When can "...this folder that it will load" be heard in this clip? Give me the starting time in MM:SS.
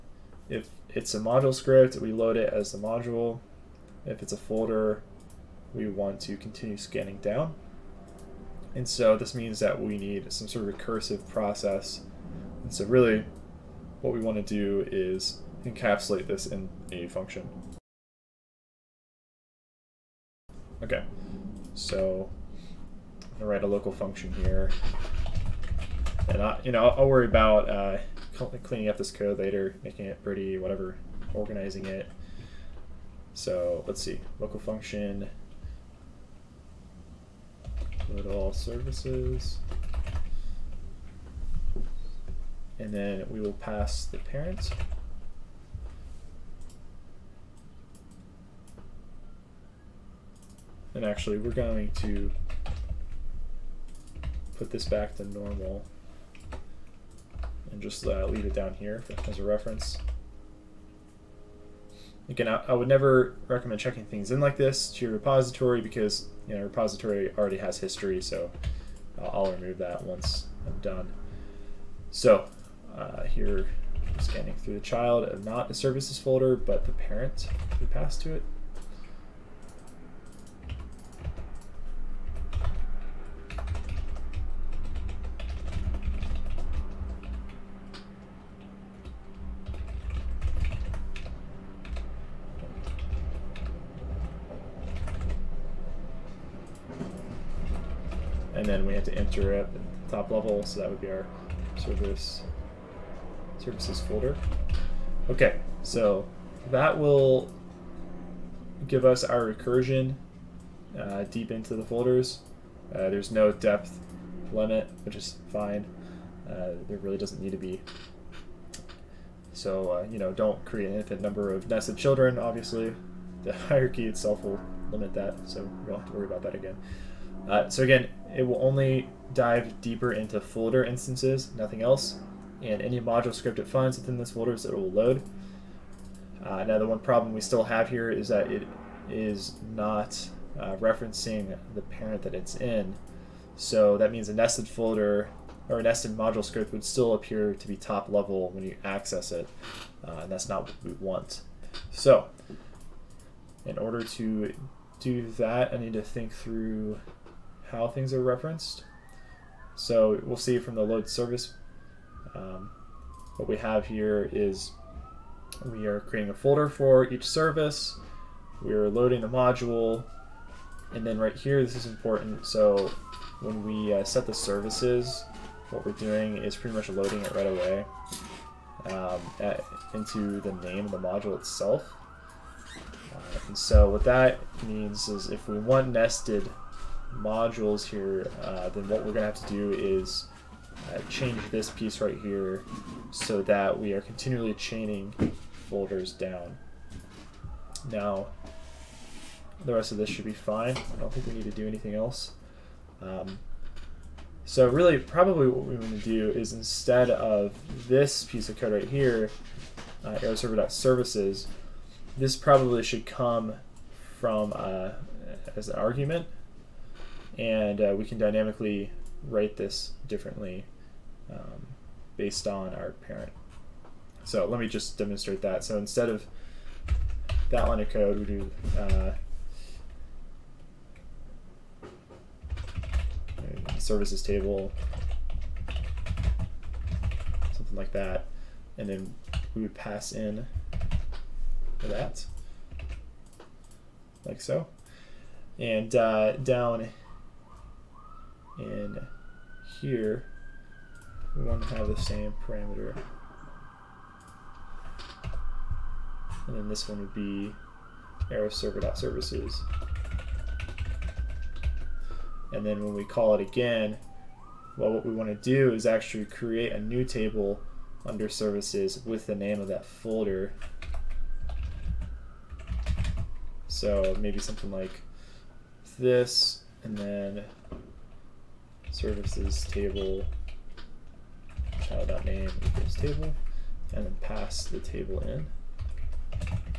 02:14.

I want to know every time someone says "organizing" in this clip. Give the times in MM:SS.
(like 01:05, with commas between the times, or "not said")
00:31.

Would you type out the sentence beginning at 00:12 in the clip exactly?
And so really what we want to do is encapsulate this in a function.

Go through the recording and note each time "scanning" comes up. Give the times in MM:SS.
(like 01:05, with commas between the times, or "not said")
00:06, 01:14.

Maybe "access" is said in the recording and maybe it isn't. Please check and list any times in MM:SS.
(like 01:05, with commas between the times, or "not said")
02:28.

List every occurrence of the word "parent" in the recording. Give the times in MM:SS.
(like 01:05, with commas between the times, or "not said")
00:44, 01:16, 02:21, 03:43.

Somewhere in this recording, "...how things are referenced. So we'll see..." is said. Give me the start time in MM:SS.
02:37.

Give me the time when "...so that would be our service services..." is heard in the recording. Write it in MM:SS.
01:40.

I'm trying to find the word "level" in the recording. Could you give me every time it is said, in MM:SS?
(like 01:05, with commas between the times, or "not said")
01:40, 02:28.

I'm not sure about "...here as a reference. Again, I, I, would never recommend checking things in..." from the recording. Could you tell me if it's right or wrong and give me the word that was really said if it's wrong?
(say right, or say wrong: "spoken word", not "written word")
right.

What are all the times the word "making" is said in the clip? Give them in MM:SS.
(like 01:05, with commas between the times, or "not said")
00:29.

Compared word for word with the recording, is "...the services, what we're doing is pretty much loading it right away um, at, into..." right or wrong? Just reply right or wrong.
right.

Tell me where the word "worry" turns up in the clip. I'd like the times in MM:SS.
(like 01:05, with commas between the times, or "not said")
00:27, 02:06.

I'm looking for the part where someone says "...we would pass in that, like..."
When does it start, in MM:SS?
03:59.